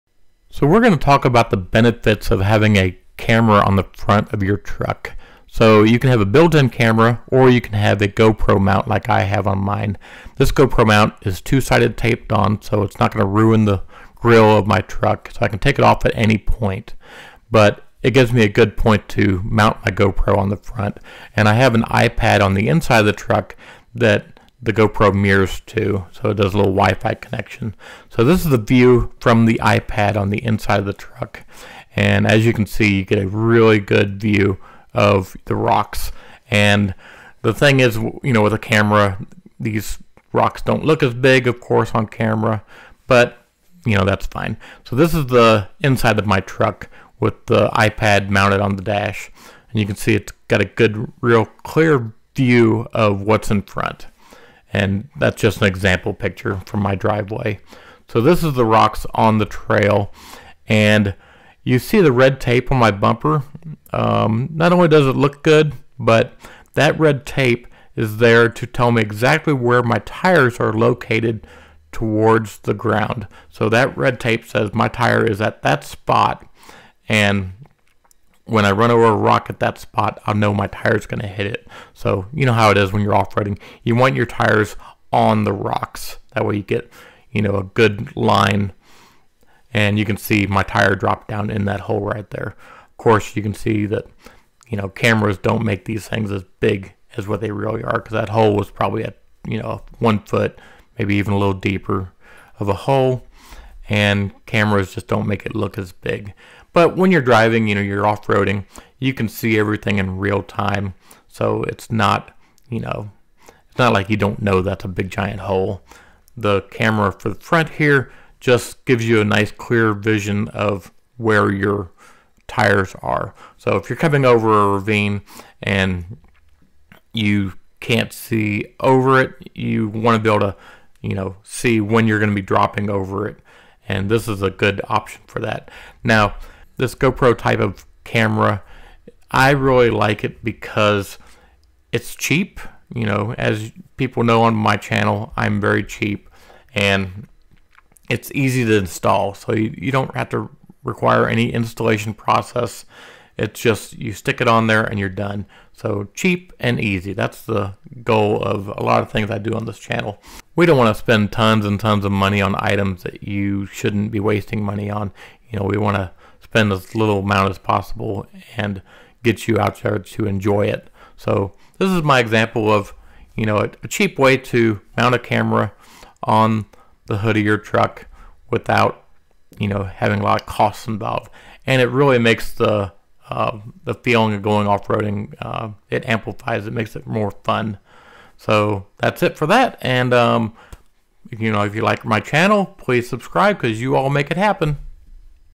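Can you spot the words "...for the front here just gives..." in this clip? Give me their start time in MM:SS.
01:57.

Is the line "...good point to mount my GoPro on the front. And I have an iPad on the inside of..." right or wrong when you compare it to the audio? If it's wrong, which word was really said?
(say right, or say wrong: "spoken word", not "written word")
right.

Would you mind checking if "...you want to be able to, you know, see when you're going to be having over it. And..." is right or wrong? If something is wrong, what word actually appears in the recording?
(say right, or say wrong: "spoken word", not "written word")
wrong: "dropping", not "having".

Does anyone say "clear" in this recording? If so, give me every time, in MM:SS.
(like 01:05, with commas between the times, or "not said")
00:51, 01:59.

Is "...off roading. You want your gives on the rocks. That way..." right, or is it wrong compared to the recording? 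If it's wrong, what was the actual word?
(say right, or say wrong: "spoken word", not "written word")
wrong: "tires", not "gives".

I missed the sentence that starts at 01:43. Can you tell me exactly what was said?
And cameras just don't make it look as big.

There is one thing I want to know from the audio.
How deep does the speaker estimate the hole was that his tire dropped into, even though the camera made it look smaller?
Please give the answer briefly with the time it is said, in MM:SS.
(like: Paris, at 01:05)
1 foot, at 01:39.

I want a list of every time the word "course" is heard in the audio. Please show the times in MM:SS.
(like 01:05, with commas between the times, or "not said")
00:41, 01:32.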